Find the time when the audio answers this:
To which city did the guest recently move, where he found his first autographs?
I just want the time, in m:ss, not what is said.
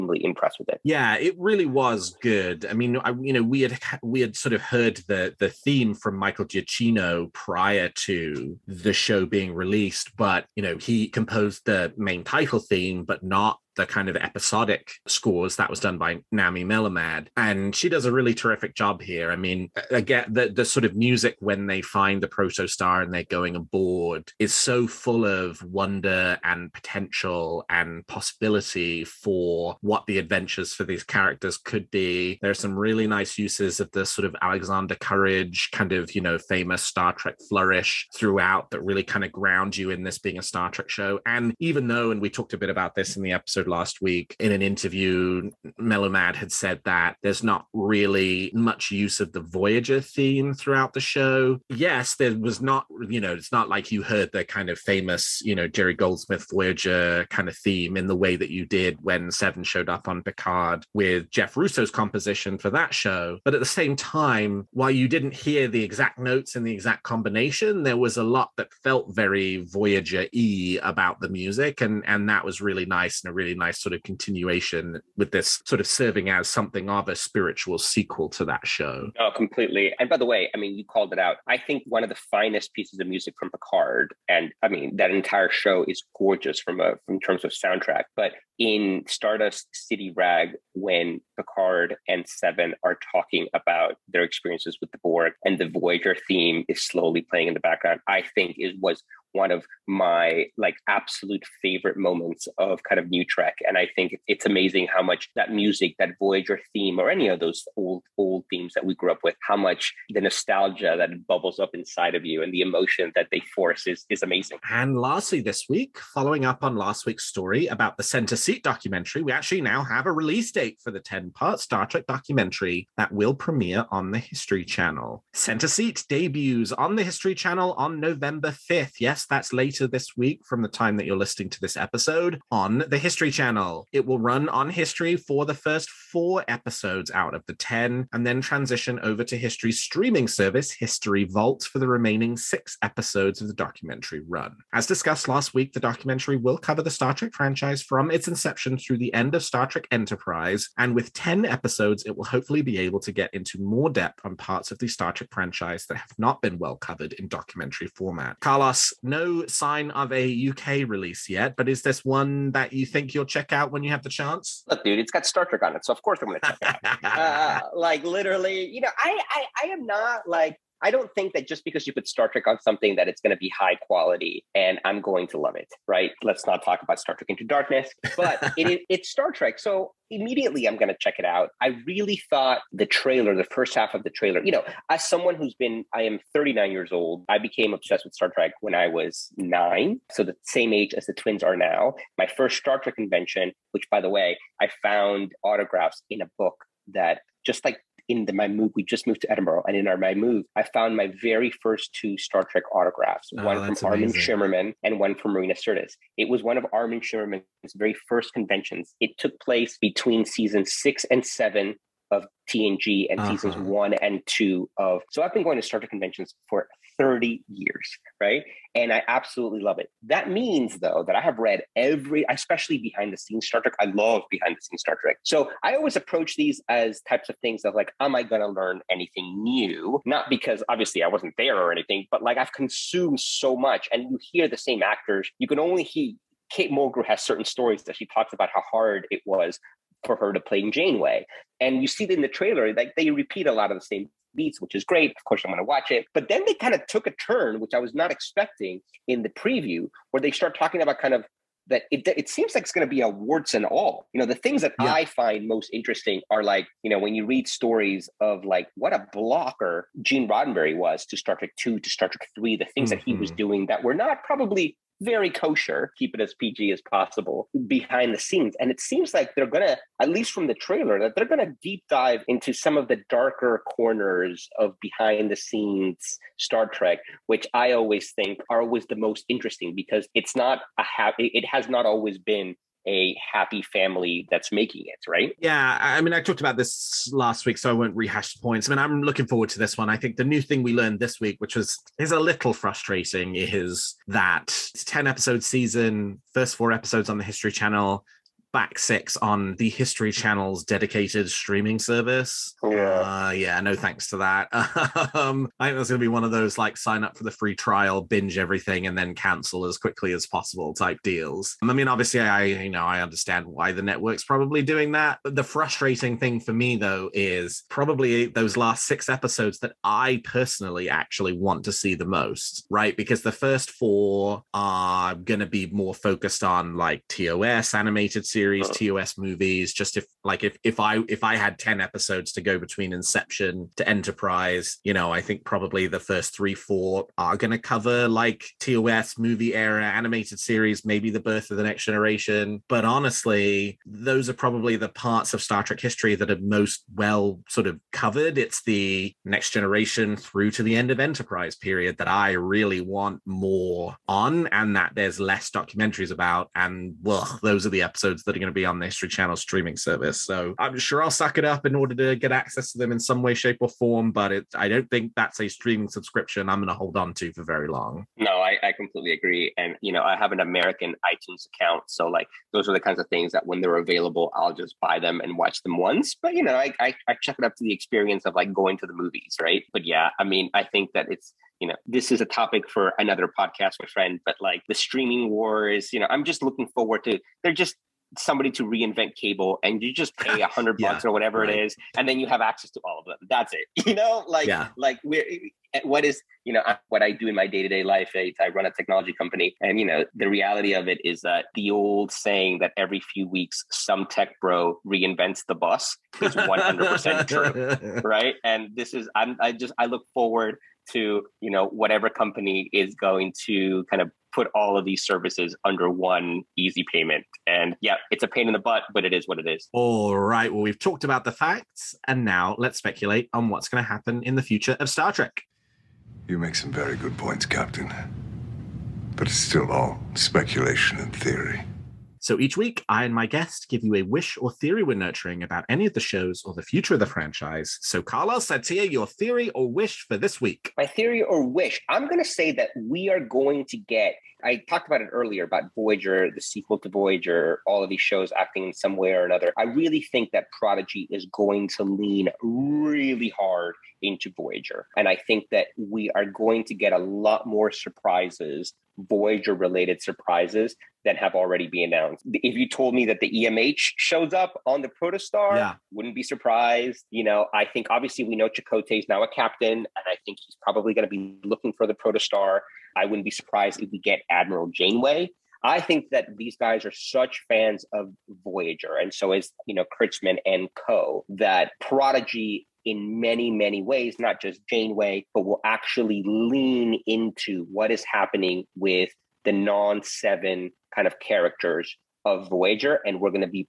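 3:19.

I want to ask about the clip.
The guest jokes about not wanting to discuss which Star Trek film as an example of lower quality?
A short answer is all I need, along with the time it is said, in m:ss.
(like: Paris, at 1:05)
Star Trek Into Darkness, at 2:56.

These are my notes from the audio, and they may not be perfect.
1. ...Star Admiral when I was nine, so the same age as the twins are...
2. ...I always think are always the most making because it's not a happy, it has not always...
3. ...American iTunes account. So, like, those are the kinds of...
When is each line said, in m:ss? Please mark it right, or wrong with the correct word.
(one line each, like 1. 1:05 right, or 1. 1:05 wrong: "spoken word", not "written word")
1. 3:08 wrong: "Trek", not "Admiral"
2. 4:37 wrong: "interesting", not "making"
3. 6:10 right.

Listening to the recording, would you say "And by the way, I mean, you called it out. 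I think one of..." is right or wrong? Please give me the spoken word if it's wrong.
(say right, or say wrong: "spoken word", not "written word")
right.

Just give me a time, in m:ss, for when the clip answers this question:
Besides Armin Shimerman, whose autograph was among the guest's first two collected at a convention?
3:25.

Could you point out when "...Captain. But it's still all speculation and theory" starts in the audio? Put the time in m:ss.
7:07.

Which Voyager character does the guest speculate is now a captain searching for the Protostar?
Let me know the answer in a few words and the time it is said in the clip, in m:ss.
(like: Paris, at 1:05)
Chakotay, at 7:48.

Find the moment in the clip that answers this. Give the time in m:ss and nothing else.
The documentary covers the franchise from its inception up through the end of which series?
2:29.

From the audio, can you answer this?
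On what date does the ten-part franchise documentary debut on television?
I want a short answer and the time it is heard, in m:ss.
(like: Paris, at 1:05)
November 5th, at 2:07.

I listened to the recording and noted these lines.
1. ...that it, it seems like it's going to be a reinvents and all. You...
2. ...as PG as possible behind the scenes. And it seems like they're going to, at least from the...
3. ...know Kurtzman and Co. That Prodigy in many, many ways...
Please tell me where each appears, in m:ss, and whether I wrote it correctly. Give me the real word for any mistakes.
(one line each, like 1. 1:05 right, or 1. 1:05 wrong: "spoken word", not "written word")
1. 4:11 wrong: "warts", not "reinvents"
2. 4:26 right
3. 7:59 right.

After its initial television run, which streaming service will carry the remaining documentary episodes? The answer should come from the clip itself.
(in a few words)
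History Vault.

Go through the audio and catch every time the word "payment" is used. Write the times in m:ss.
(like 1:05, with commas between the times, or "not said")
6:56.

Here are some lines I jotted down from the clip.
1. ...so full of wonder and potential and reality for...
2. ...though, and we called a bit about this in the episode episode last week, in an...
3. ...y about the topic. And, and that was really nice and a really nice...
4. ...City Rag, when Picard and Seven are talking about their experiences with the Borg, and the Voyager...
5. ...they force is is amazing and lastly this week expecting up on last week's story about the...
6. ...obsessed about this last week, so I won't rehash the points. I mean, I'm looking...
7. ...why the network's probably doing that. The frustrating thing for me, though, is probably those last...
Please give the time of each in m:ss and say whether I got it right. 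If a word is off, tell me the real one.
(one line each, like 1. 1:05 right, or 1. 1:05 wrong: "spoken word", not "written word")
1. 0:24 wrong: "possibility", not "reality"
2. 0:41 wrong: "talked", not "called"
3. 1:10 wrong: "music", not "topic"
4. 1:29 right
5. 1:53 wrong: "following", not "expecting"
6. 4:46 wrong: "talked", not "obsessed"
7. 5:13 right.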